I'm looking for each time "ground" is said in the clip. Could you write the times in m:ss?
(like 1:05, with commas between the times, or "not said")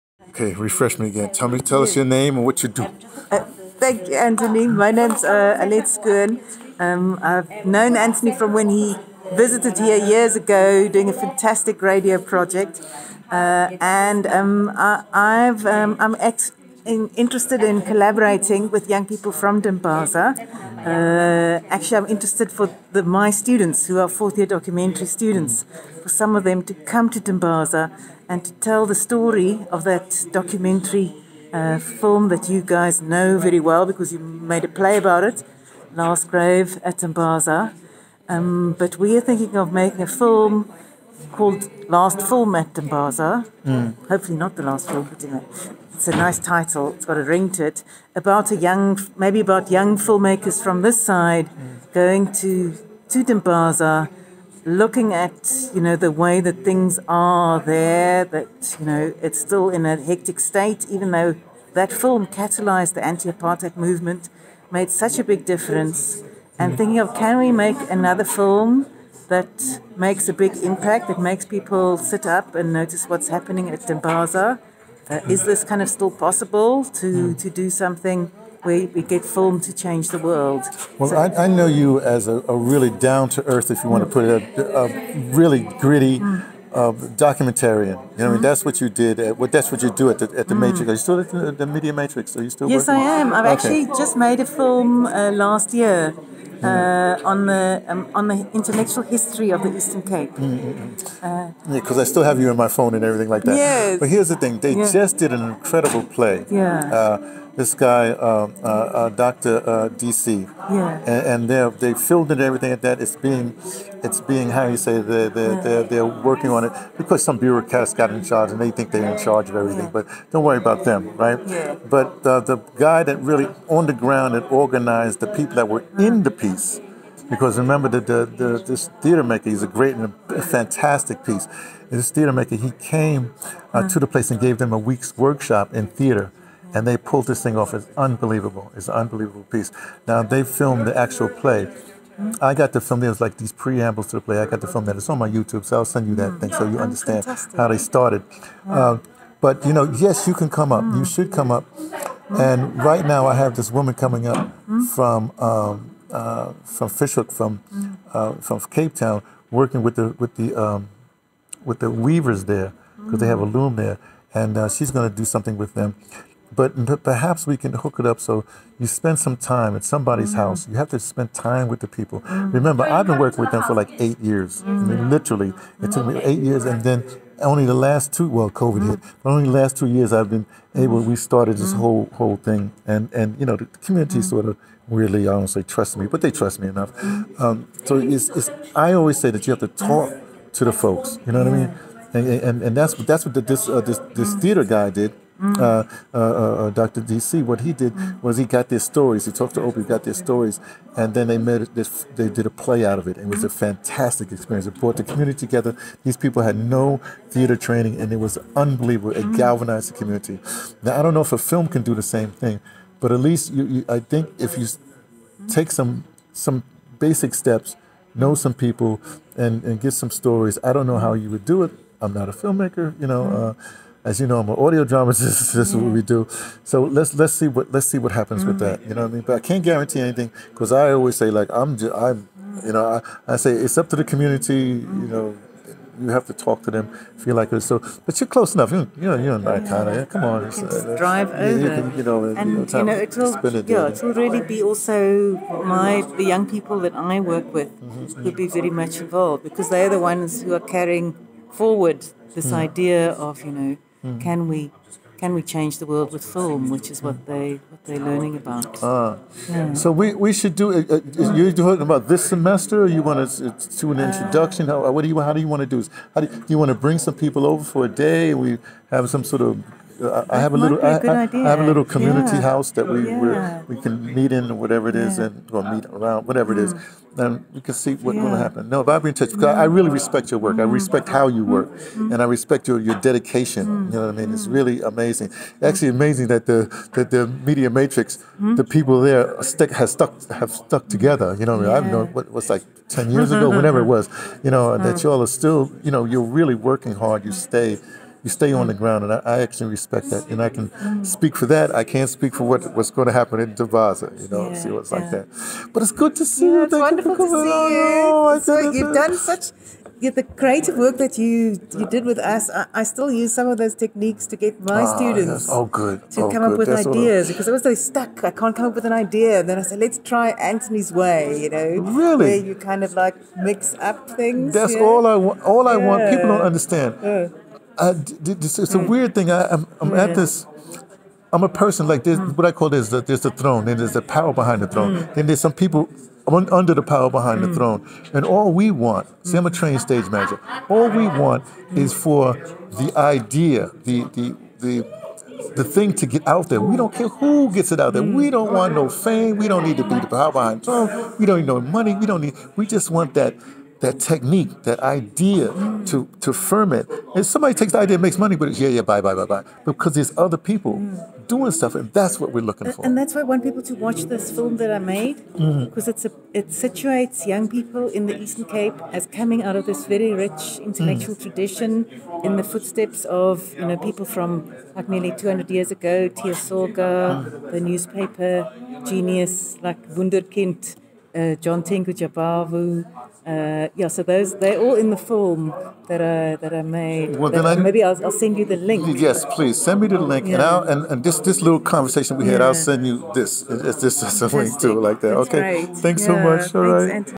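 2:03, 4:58.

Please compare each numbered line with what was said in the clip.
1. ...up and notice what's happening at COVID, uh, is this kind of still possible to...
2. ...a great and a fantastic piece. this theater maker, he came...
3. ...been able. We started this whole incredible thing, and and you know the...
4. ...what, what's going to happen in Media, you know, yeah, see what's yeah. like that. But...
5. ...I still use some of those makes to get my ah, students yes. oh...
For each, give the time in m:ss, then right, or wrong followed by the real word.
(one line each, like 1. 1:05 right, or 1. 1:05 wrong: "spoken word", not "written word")
1. 1:12 wrong: "Dimbaza", not "COVID"
2. 2:09 right
3. 3:00 wrong: "whole", not "incredible"
4. 5:02 wrong: "Dimbaza", not "Media"
5. 5:12 wrong: "techniques", not "makes".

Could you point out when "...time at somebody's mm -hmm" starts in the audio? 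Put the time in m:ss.
2:49.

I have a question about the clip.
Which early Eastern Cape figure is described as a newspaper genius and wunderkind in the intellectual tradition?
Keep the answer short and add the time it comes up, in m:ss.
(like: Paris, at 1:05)
Tiyo Soga, at 6:16.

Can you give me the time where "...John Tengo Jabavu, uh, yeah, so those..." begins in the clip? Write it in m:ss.
6:21.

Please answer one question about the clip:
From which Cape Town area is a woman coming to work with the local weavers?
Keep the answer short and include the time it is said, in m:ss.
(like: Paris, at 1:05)
Fish Hoek, at 2:36.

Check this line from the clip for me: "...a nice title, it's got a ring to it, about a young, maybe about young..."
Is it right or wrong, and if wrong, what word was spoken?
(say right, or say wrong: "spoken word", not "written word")
right.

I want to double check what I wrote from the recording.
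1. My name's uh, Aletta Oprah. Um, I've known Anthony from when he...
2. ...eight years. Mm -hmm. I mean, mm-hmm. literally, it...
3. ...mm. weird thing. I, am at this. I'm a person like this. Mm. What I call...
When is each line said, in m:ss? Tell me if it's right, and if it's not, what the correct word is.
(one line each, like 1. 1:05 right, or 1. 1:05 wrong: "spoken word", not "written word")
1. 0:04 wrong: "Skern", not "Oprah"
2. 2:54 right
3. 5:28 right.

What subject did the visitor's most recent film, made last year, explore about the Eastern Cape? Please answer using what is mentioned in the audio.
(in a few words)
Intellectual history.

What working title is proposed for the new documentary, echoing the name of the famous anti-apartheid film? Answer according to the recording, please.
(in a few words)
Last Film at Dimbaza.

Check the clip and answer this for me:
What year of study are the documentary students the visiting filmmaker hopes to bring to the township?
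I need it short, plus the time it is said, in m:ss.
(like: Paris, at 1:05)
Fourth year, at 0:24.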